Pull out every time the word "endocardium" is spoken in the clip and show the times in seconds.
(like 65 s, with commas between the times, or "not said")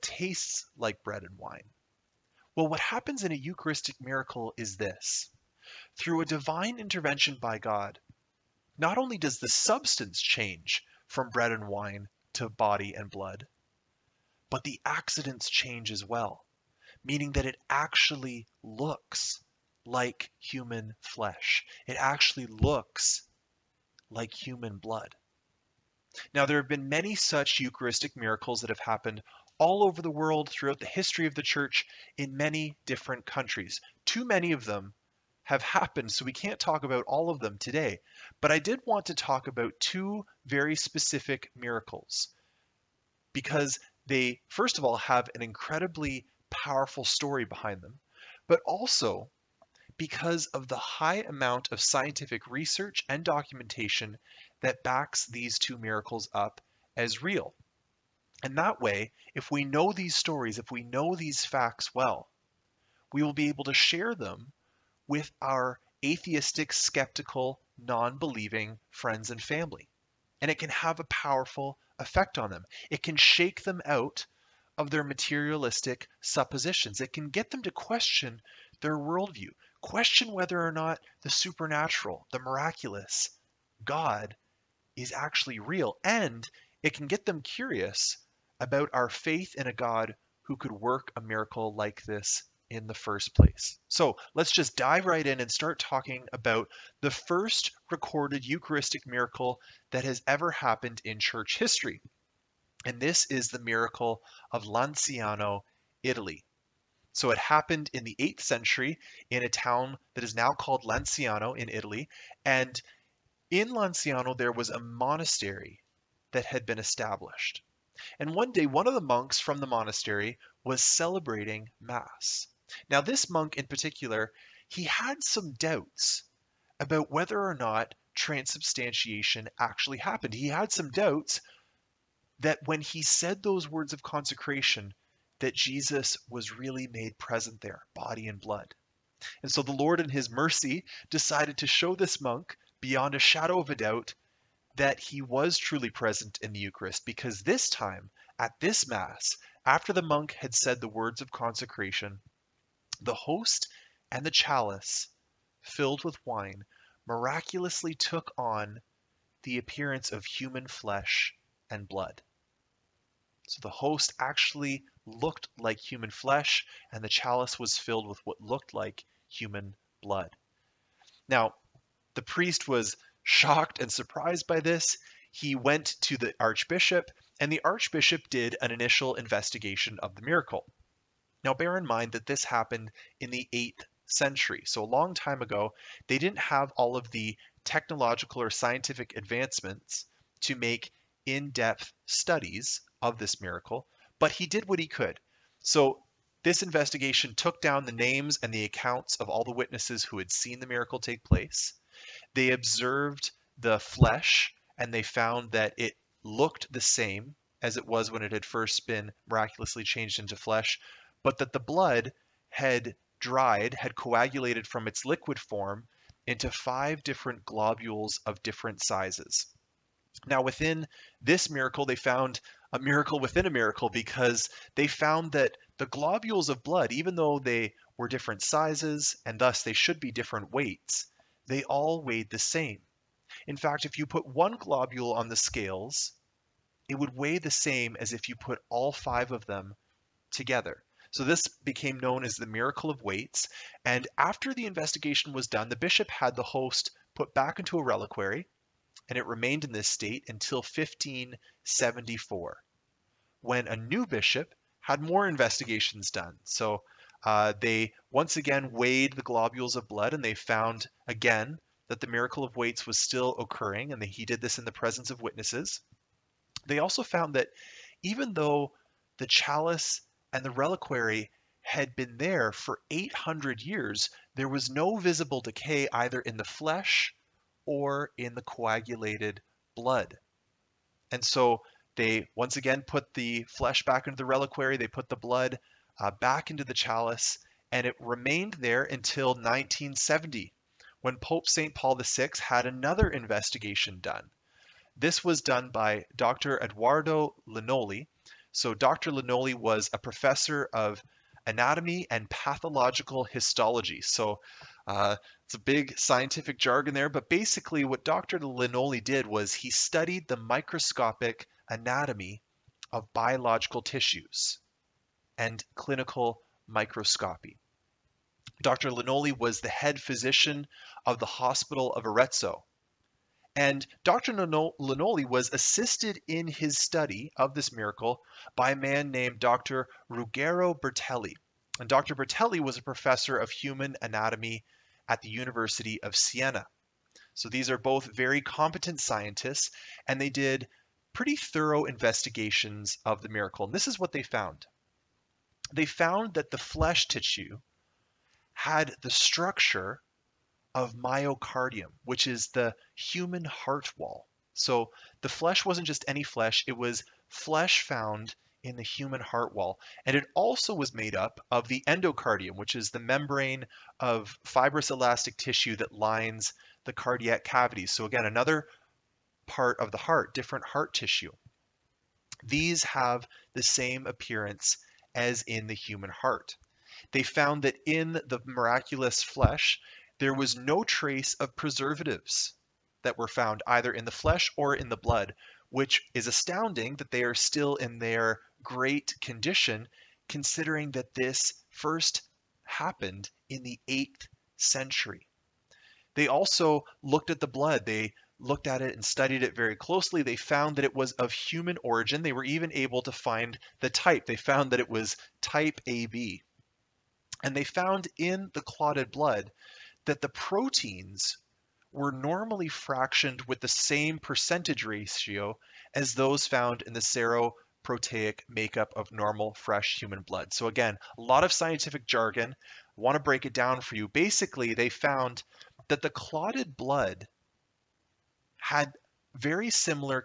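361 s.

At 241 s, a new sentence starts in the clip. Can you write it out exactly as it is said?
So this became known as the miracle of weights.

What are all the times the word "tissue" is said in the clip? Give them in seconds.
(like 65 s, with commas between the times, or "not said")
313 s, 347 s, 365 s, 370 s.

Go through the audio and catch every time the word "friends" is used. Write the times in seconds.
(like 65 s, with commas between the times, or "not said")
68 s.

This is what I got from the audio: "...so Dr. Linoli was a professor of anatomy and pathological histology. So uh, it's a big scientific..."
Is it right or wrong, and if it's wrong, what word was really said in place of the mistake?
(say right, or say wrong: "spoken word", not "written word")
right.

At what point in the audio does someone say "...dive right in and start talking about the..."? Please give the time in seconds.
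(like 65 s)
94 s.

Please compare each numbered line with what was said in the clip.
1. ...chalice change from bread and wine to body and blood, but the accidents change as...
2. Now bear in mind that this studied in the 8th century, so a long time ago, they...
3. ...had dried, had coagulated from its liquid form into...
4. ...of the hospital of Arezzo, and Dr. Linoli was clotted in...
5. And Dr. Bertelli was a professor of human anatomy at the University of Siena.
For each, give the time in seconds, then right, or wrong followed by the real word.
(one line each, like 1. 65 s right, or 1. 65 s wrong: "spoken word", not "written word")
1. 9 s wrong: "substance", not "chalice"
2. 181 s wrong: "happened", not "studied"
3. 212 s right
4. 321 s wrong: "assisted", not "clotted"
5. 331 s right.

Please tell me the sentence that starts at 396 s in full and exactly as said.
They also looked at the blood.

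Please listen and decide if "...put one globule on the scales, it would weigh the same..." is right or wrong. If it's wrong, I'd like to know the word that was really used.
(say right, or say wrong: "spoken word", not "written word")
right.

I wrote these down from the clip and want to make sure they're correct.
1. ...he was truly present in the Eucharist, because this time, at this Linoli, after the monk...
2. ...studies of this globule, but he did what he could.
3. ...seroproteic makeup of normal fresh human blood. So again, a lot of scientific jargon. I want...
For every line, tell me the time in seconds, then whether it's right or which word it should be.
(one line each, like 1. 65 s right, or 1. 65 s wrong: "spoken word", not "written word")
1. 144 s wrong: "Mass", not "Linoli"
2. 192 s wrong: "miracle", not "globule"
3. 416 s right.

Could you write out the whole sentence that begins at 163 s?
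So the host actually looked like human flesh, and the chalice was filled with what looked like human blood.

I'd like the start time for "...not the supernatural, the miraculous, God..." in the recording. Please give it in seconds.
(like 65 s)
80 s.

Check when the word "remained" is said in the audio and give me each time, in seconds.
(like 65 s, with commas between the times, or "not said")
249 s, 287 s.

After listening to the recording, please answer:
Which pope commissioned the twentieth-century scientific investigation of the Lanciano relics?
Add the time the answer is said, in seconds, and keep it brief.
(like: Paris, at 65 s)
Pope St. Paul VI, at 291 s.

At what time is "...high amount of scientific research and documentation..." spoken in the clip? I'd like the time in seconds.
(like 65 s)
50 s.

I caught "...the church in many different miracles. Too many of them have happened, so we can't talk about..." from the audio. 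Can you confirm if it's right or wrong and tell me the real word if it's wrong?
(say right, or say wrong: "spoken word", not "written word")
wrong: "countries", not "miracles".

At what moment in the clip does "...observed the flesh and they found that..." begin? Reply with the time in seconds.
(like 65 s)
202 s.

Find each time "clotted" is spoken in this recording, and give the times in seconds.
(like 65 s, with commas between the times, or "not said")
408 s, 426 s.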